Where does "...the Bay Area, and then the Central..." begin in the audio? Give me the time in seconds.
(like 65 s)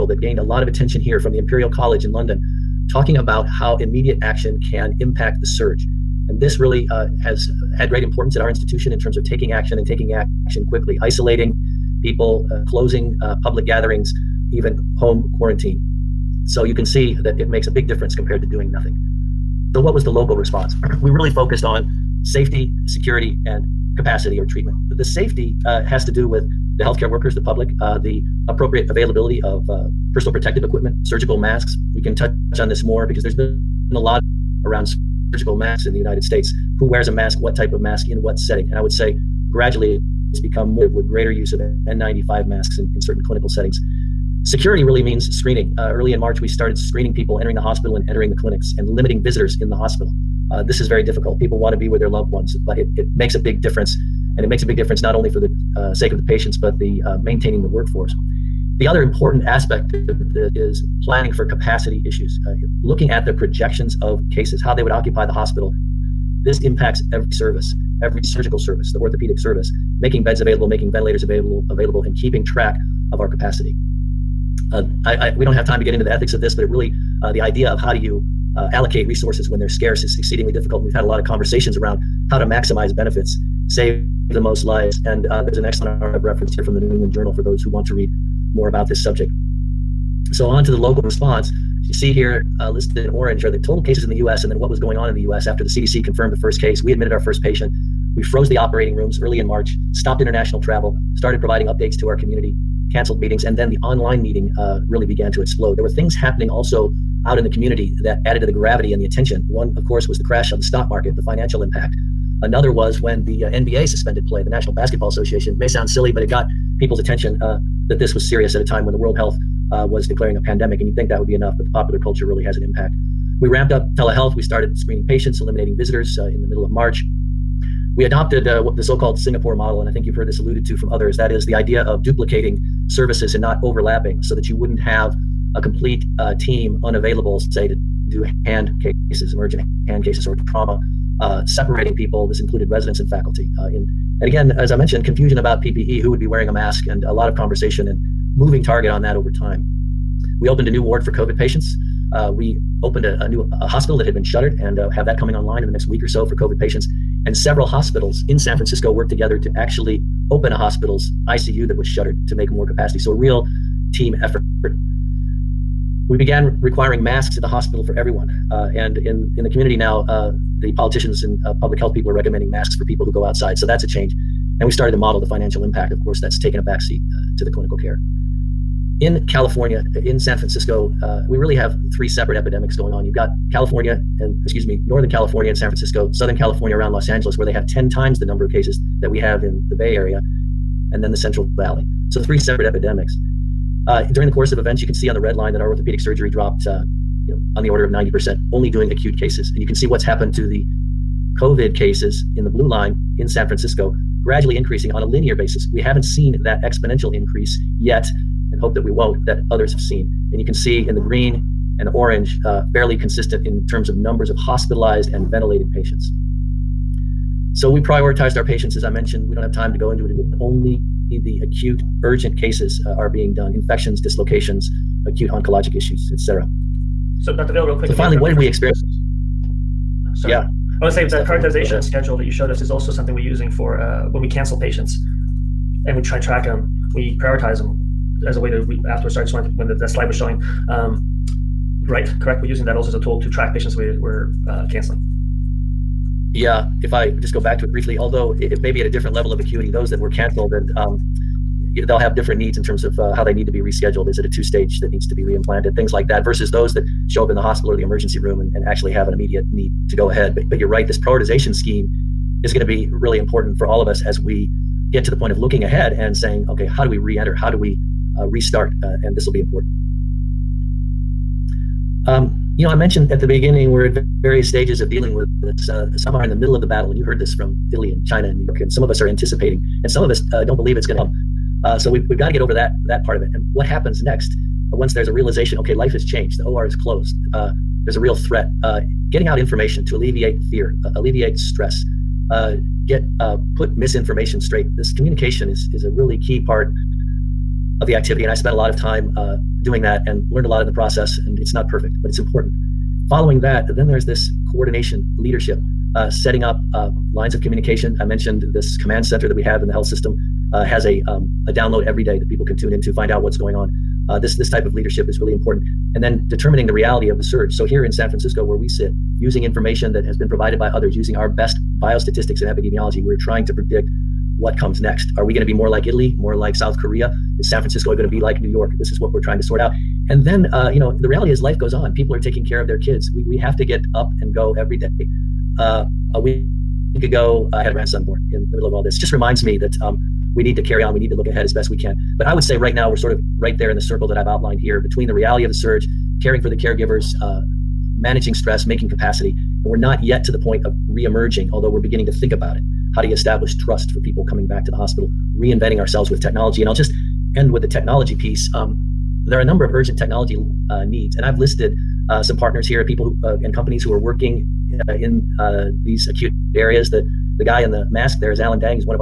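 189 s.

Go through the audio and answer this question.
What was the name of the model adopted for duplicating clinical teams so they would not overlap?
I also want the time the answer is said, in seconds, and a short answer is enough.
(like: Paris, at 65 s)
Singapore model, at 129 s.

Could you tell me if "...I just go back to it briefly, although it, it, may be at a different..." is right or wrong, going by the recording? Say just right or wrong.
right.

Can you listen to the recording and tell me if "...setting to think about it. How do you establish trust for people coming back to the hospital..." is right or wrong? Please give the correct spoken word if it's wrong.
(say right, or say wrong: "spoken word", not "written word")
wrong: "beginning", not "setting".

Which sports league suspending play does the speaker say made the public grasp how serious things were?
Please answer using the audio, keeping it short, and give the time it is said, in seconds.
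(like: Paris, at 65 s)
National Basketball Association, at 114 s.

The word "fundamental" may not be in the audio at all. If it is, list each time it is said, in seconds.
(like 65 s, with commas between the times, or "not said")
not said.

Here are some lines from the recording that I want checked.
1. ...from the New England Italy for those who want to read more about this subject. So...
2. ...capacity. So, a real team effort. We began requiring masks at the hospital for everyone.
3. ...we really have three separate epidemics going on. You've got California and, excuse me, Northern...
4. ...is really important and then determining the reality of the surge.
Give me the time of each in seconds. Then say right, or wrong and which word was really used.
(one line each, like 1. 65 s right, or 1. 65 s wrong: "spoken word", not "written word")
1. 86 s wrong: "Journal", not "Italy"
2. 162 s right
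3. 181 s right
4. 315 s right.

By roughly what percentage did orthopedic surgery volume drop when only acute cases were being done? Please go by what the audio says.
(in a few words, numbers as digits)
90%.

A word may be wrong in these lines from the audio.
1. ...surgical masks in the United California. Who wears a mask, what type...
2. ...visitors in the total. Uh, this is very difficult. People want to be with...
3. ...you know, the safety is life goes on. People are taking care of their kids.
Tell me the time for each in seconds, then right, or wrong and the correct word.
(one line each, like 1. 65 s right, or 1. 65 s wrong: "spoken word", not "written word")
1. 35 s wrong: "States", not "California"
2. 49 s wrong: "hospital", not "total"
3. 330 s wrong: "reality", not "safety".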